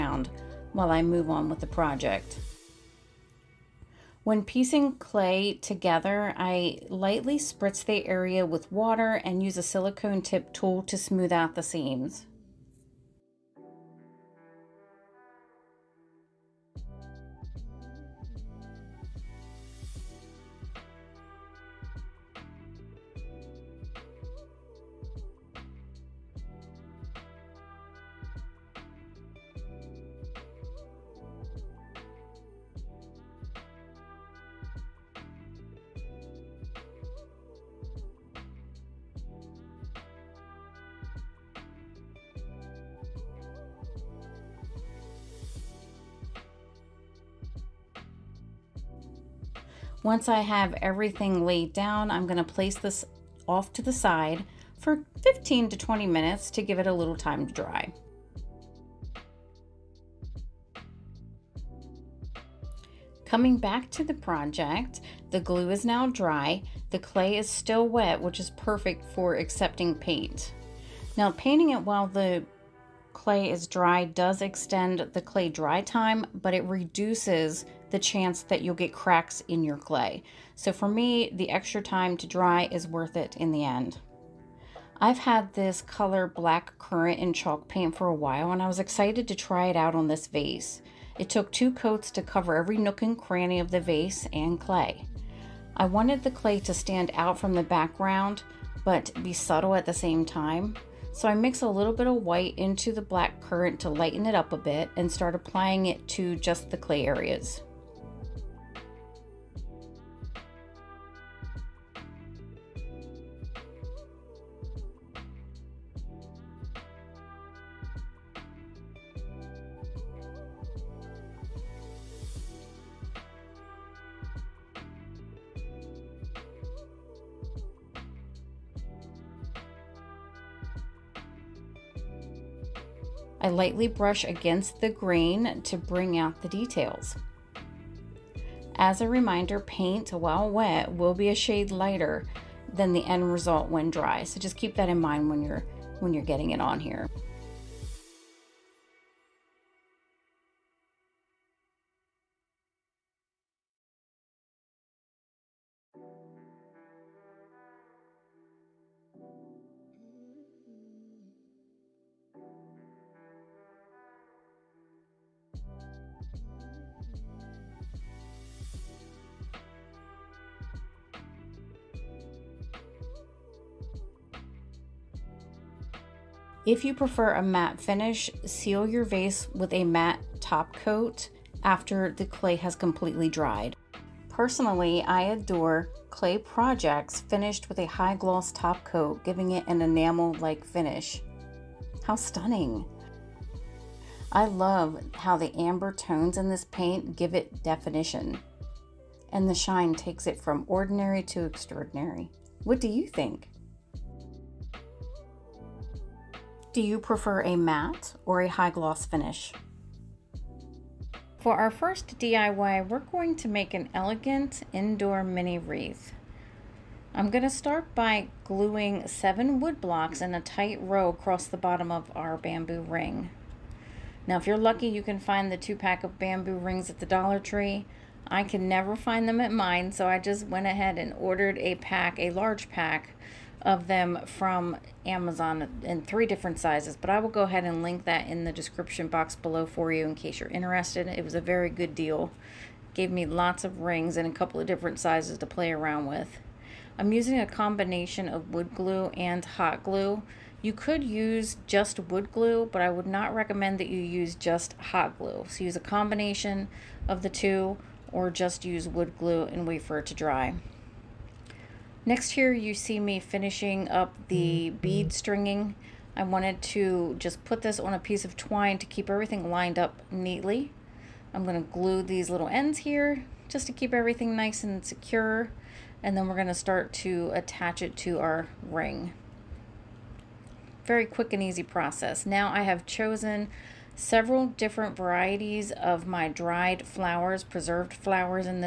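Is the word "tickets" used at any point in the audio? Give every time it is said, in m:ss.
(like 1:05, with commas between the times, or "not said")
not said.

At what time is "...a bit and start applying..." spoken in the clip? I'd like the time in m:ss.
1:44.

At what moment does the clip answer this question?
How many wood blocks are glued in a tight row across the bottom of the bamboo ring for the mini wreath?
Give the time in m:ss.
3:39.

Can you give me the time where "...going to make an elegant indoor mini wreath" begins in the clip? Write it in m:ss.
3:32.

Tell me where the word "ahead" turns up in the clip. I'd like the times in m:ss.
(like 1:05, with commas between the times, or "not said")
3:50, 3:57.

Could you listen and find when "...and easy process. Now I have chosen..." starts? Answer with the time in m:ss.
4:41.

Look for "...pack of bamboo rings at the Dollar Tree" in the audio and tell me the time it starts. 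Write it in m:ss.
3:45.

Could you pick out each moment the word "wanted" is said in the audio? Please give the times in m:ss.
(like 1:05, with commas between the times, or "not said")
1:35, 4:26.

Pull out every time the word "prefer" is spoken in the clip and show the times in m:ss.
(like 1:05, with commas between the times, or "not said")
2:56, 3:26.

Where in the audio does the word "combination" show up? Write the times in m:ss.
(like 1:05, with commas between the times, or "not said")
4:07, 4:15.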